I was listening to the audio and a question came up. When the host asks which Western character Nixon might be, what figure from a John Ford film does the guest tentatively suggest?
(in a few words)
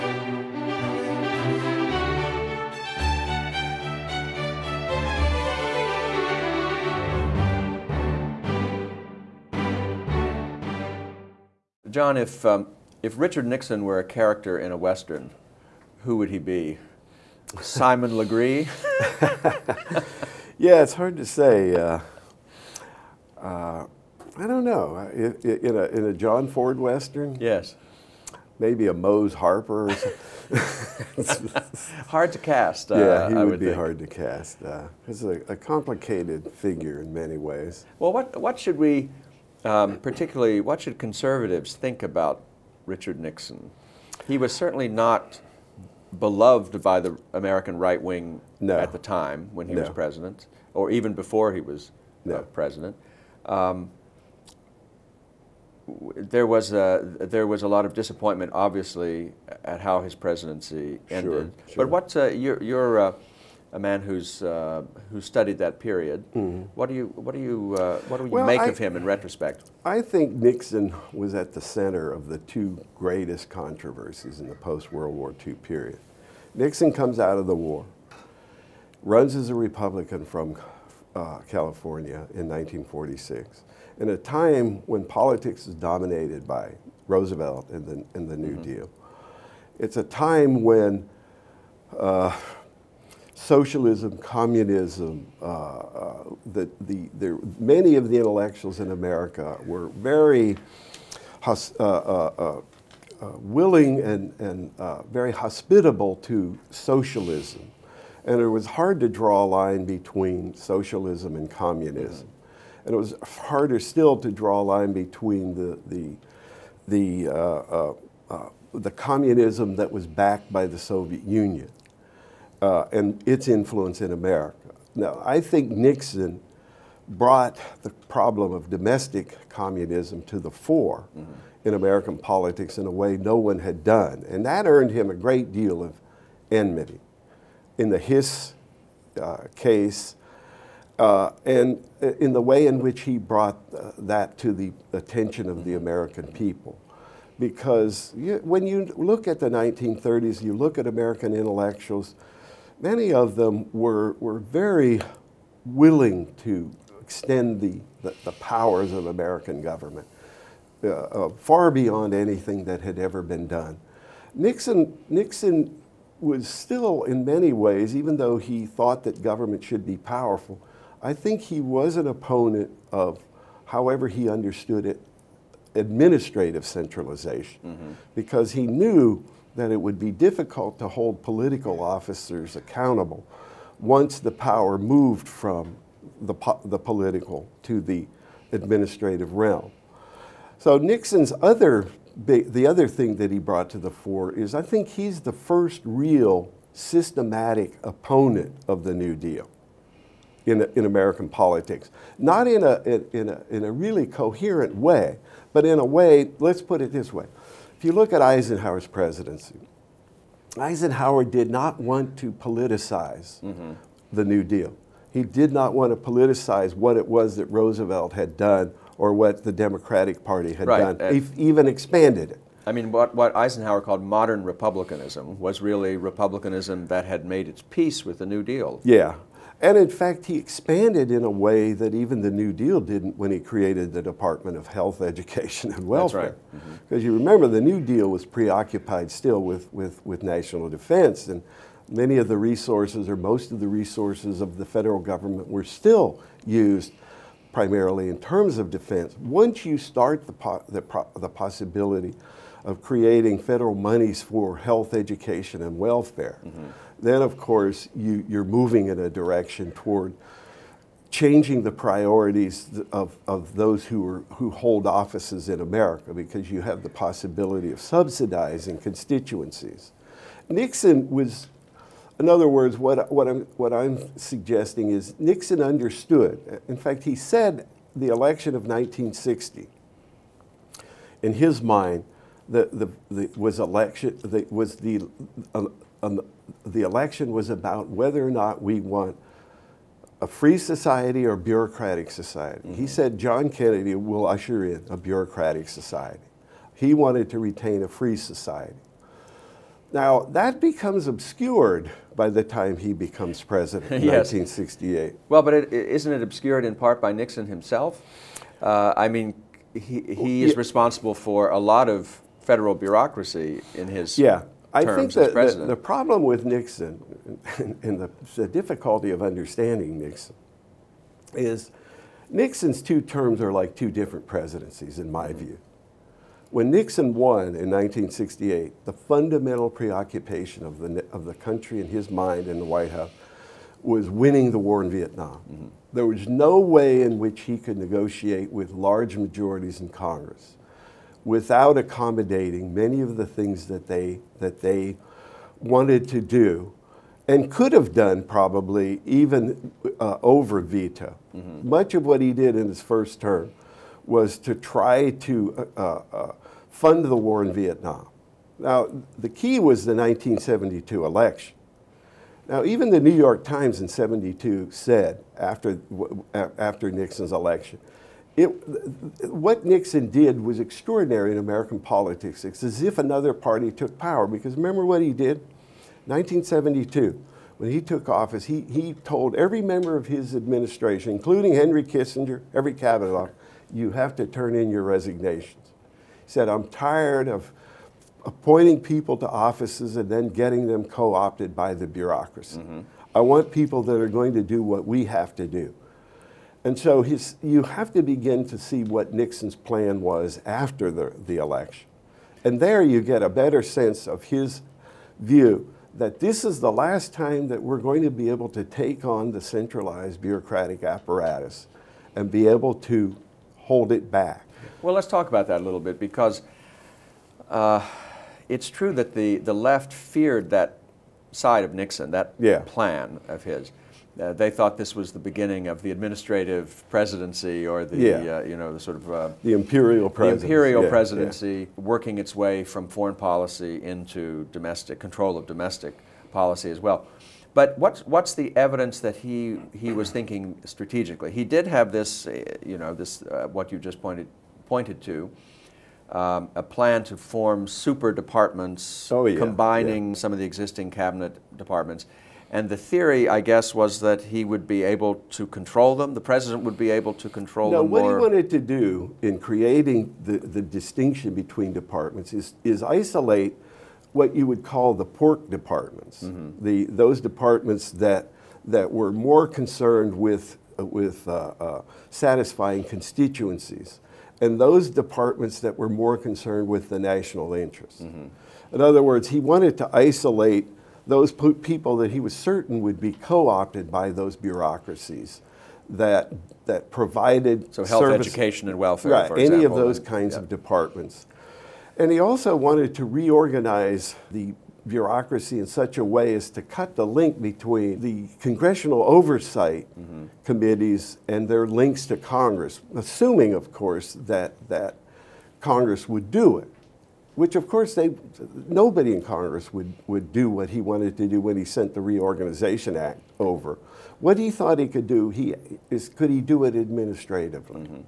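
Mose Harper.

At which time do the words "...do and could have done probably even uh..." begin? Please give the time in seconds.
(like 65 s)
346 s.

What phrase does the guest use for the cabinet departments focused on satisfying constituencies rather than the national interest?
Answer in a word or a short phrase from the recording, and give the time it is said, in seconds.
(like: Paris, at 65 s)
pork departments, at 465 s.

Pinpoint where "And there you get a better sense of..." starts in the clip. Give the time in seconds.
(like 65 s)
402 s.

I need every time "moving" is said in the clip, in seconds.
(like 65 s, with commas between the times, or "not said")
258 s.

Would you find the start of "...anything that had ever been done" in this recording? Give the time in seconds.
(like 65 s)
162 s.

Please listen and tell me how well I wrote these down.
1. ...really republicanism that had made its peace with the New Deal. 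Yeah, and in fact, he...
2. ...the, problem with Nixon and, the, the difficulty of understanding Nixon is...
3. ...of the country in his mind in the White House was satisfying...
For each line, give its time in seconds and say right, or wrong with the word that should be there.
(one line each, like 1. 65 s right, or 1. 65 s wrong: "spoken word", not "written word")
1. 225 s right
2. 315 s right
3. 331 s wrong: "winning", not "satisfying".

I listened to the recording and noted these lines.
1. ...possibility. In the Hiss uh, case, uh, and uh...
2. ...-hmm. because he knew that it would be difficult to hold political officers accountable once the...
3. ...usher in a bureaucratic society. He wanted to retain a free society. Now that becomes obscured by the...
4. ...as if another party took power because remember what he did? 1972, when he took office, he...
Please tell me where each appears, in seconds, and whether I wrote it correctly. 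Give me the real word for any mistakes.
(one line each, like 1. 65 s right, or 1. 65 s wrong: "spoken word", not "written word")
1. 136 s wrong: "enmity", not "possibility"
2. 177 s right
3. 294 s right
4. 372 s right.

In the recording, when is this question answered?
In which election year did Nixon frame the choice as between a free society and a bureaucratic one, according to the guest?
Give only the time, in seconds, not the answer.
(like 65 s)
278 s.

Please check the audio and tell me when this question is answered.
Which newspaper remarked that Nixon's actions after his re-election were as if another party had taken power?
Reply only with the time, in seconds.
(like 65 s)
363 s.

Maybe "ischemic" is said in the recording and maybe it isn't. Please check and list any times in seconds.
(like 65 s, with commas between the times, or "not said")
not said.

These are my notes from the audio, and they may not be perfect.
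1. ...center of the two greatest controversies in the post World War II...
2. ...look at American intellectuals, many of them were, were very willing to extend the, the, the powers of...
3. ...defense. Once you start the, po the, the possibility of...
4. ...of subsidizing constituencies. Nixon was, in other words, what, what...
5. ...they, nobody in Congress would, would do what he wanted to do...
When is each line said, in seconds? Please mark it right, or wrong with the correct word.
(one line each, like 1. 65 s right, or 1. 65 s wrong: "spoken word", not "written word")
1. 71 s right
2. 150 s right
3. 248 s right
4. 267 s right
5. 507 s right.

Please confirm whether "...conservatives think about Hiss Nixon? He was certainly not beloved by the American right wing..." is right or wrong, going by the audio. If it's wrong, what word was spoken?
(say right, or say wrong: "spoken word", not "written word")
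wrong: "Richard", not "Hiss".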